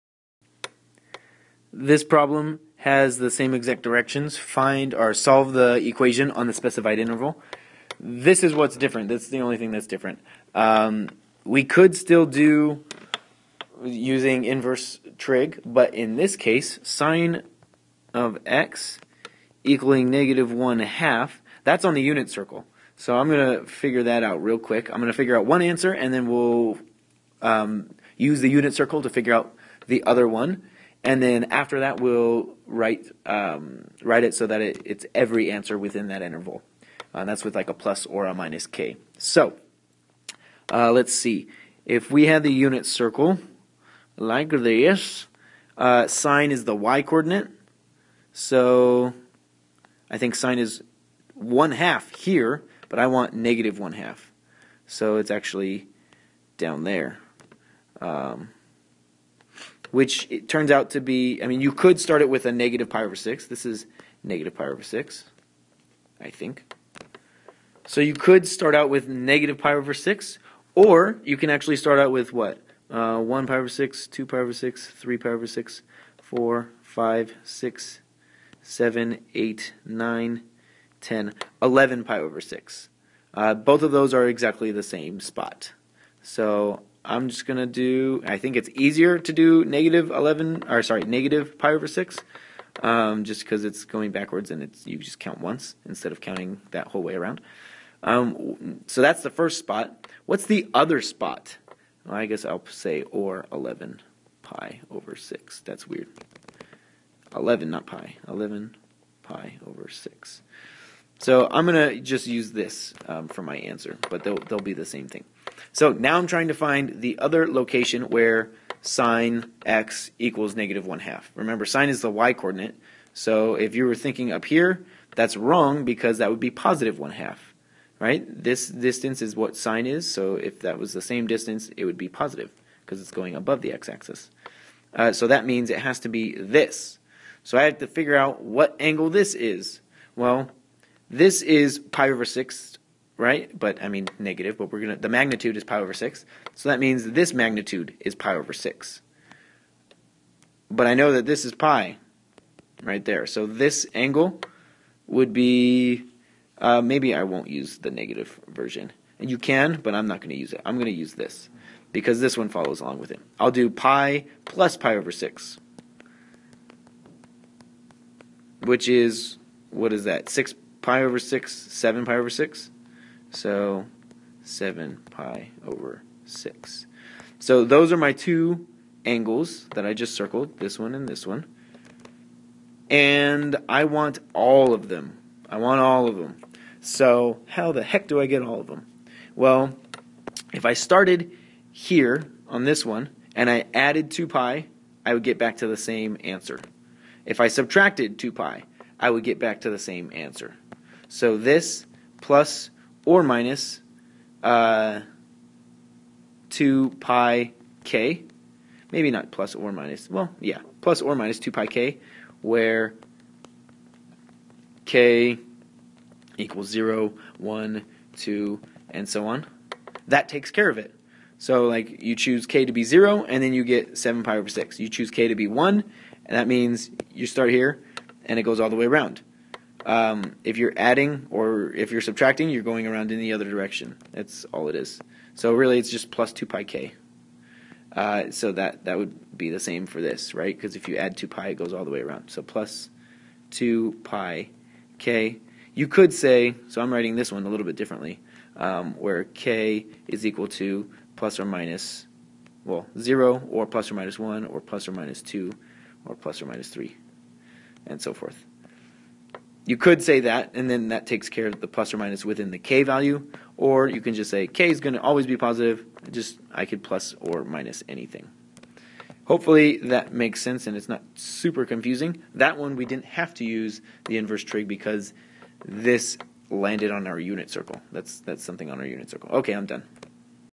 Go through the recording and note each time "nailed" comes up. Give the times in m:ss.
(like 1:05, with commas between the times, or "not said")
not said.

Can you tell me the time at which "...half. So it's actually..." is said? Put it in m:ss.
0:53.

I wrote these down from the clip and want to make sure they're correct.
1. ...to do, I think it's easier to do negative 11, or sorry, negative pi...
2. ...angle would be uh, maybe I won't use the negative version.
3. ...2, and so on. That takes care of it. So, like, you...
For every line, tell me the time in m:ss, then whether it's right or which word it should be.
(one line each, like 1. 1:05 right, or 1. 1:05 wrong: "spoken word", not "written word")
1. 1:27 right
2. 2:33 right
3. 3:38 right.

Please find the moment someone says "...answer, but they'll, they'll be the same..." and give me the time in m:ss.
1:53.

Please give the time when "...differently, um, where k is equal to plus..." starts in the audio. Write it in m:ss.
4:07.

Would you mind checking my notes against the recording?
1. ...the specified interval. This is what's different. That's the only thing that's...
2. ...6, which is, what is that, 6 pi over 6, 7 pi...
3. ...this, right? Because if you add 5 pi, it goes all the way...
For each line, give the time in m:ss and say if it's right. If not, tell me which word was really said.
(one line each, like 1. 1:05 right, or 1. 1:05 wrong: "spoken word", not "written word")
1. 0:06 right
2. 2:45 right
3. 4:00 wrong: "2", not "5".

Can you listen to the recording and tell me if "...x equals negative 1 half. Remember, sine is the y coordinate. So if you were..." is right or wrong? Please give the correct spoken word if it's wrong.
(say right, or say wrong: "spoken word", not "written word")
right.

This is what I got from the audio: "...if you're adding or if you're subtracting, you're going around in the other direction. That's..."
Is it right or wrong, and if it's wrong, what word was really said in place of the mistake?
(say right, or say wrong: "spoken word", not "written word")
right.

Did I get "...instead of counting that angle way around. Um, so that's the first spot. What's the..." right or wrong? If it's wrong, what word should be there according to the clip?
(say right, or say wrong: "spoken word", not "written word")
wrong: "whole", not "angle".